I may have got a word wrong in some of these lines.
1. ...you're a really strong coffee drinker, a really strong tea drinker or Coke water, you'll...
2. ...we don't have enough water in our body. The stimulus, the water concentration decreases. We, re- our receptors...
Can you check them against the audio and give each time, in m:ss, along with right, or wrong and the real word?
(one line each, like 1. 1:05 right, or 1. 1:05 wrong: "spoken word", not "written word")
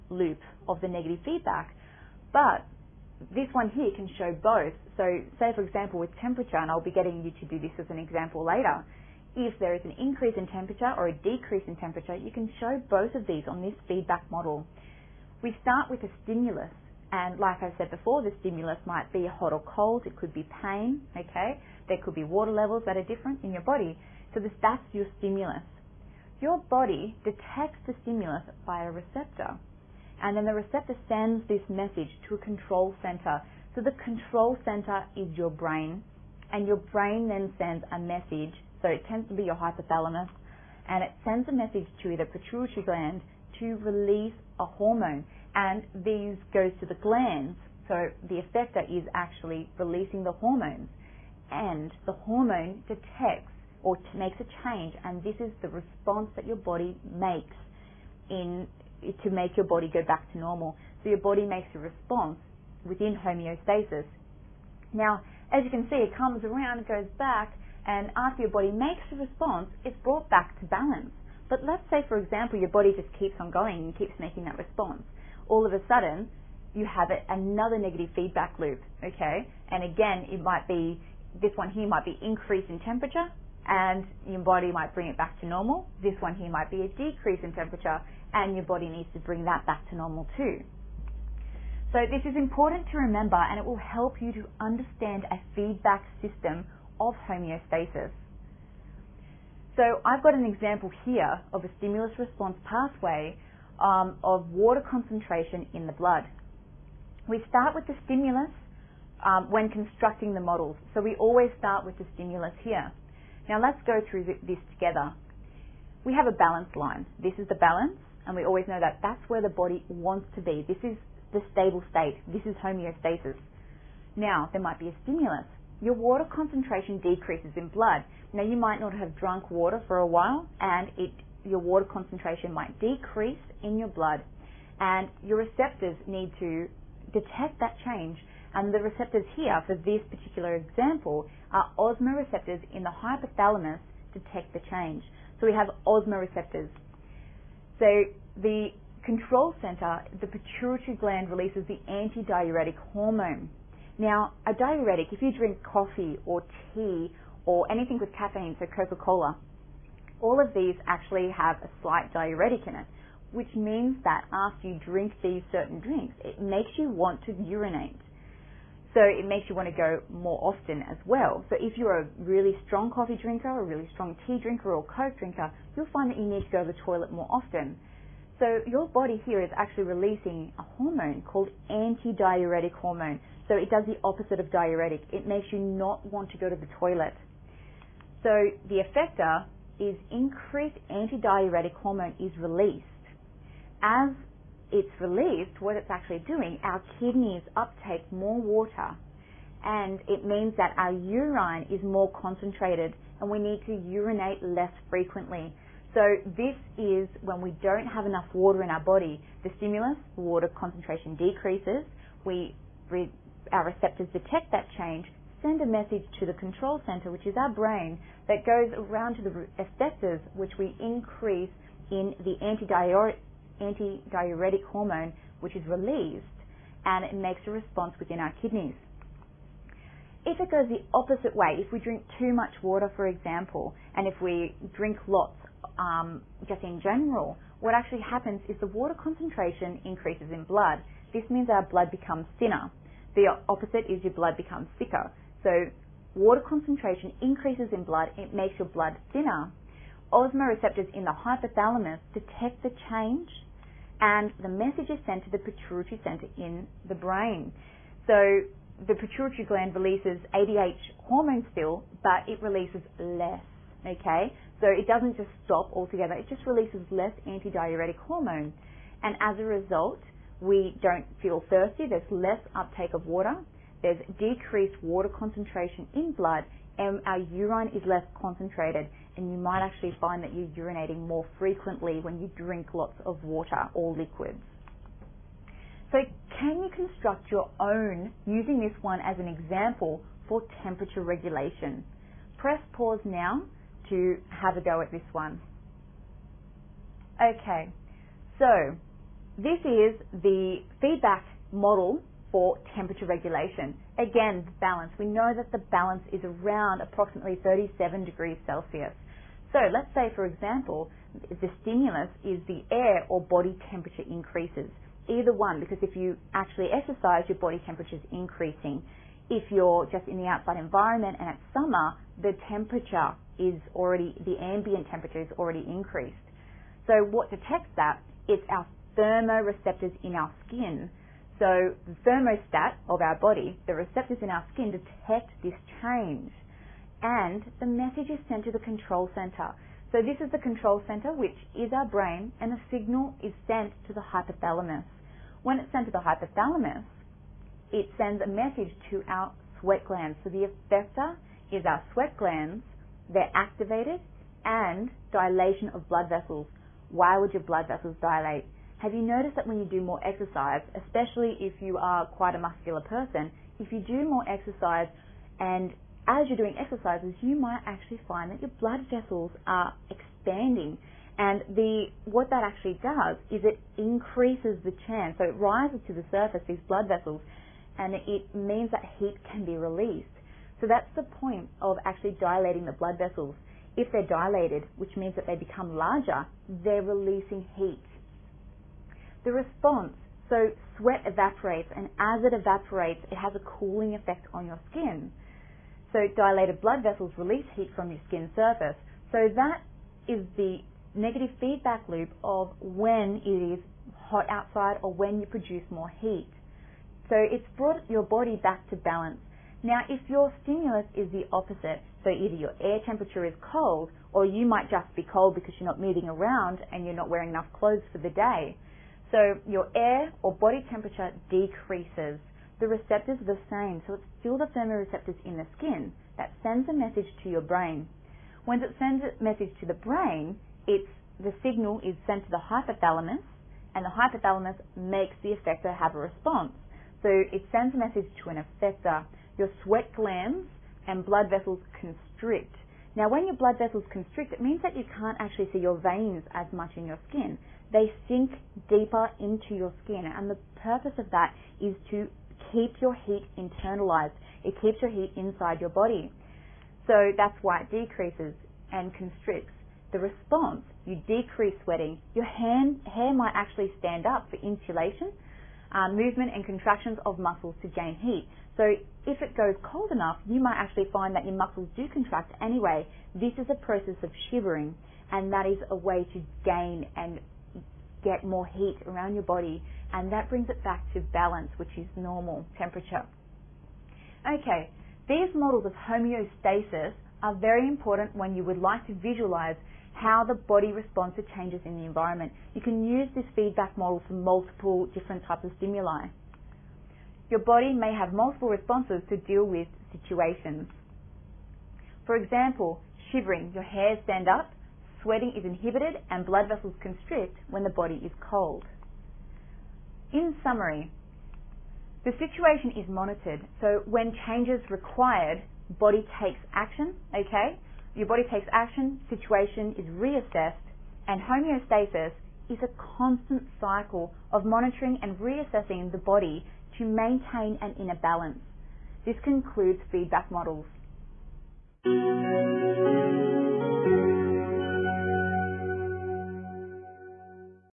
1. 2:51 wrong: "drinker", not "water"
2. 3:27 right.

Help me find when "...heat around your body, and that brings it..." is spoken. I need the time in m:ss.
7:58.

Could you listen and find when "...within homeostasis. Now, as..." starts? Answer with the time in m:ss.
1:02.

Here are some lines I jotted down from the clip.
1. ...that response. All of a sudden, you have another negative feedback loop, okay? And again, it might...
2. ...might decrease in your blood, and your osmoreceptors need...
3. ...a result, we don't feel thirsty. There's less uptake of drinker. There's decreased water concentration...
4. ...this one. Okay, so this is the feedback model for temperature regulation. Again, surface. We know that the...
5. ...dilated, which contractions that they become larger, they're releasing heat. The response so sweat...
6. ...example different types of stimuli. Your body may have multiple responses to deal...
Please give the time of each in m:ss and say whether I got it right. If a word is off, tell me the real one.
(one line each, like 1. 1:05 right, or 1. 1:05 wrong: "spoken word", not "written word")
1. 1:14 right
2. 2:12 wrong: "receptors", not "osmoreceptors"
3. 4:29 wrong: "water", not "drinker"
4. 4:54 wrong: "balance", not "surface"
5. 6:24 wrong: "means", not "contractions"
6. 8:14 wrong: "multiple", not "example".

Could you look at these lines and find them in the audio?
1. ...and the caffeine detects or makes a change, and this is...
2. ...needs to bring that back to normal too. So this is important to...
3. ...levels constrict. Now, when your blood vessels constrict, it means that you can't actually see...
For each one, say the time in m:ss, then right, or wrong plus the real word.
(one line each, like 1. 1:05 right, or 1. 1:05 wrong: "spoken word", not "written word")
1. 0:51 wrong: "hormone", not "caffeine"
2. 1:28 right
3. 7:21 wrong: "vessels", not "levels".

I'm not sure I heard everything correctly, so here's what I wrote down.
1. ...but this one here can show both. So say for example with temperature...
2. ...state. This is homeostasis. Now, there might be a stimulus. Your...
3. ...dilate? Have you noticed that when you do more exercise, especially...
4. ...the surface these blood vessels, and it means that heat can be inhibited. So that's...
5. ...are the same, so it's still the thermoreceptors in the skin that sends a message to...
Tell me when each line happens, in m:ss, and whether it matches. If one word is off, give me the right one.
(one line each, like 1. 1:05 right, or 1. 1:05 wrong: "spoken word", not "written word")
1. 0:02 right
2. 2:01 right
3. 5:57 right
4. 6:15 wrong: "released", not "inhibited"
5. 7:03 right.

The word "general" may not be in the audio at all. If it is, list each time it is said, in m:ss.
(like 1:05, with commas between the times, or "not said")
3:56.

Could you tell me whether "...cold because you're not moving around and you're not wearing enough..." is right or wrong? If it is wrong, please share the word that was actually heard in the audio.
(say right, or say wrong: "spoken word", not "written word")
right.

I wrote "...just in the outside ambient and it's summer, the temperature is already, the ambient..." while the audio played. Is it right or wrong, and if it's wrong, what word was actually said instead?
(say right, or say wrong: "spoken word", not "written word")
wrong: "environment", not "ambient".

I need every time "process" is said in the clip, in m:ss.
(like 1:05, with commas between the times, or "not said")
7:53.